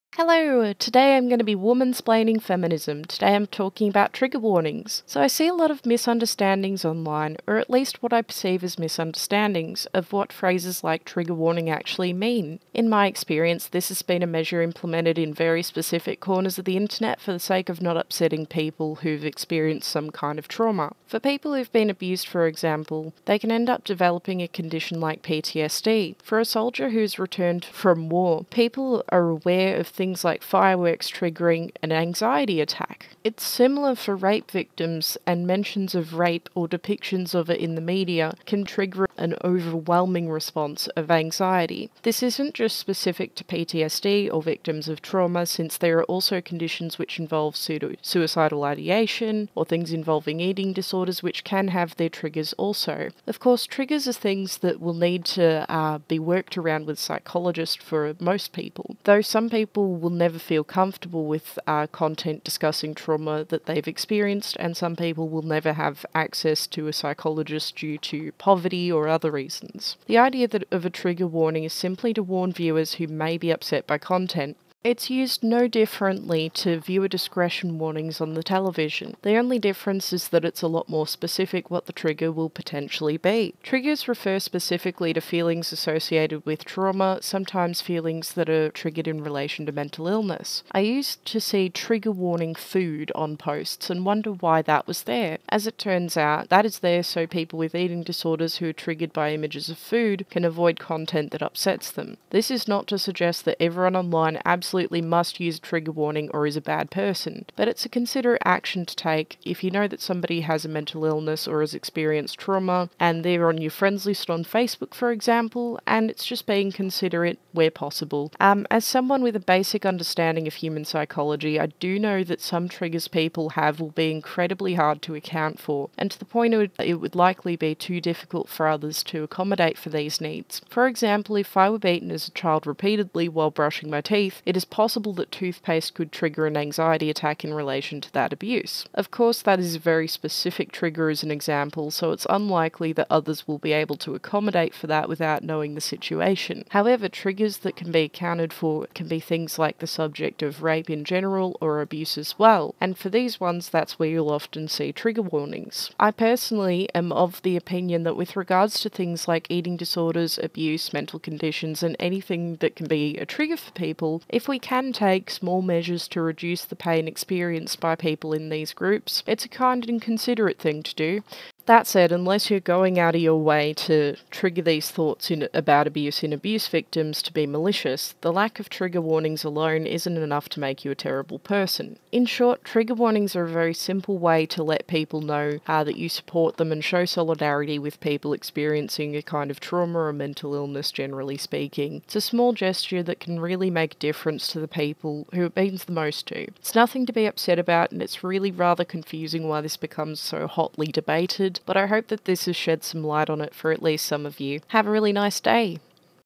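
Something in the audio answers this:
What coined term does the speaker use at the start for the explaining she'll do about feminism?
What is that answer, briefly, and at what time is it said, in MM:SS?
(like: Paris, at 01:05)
woman-splaining, at 00:01.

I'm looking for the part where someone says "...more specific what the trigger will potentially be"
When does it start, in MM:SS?
01:20.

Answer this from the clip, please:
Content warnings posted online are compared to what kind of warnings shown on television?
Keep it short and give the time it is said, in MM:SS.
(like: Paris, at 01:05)
viewer discretion warnings, at 01:16.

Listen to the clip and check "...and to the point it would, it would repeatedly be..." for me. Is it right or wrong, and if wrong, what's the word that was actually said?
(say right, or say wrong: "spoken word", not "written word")
wrong: "likely", not "repeatedly".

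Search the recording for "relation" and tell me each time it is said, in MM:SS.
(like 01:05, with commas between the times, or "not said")
01:29, 02:17.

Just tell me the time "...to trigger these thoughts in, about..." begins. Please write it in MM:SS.
02:53.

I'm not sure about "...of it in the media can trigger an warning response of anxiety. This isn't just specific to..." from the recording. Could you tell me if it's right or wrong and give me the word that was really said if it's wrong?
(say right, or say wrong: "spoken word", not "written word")
wrong: "overwhelming", not "warning".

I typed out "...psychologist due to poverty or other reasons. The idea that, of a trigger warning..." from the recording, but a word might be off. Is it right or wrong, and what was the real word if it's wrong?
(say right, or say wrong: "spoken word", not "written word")
right.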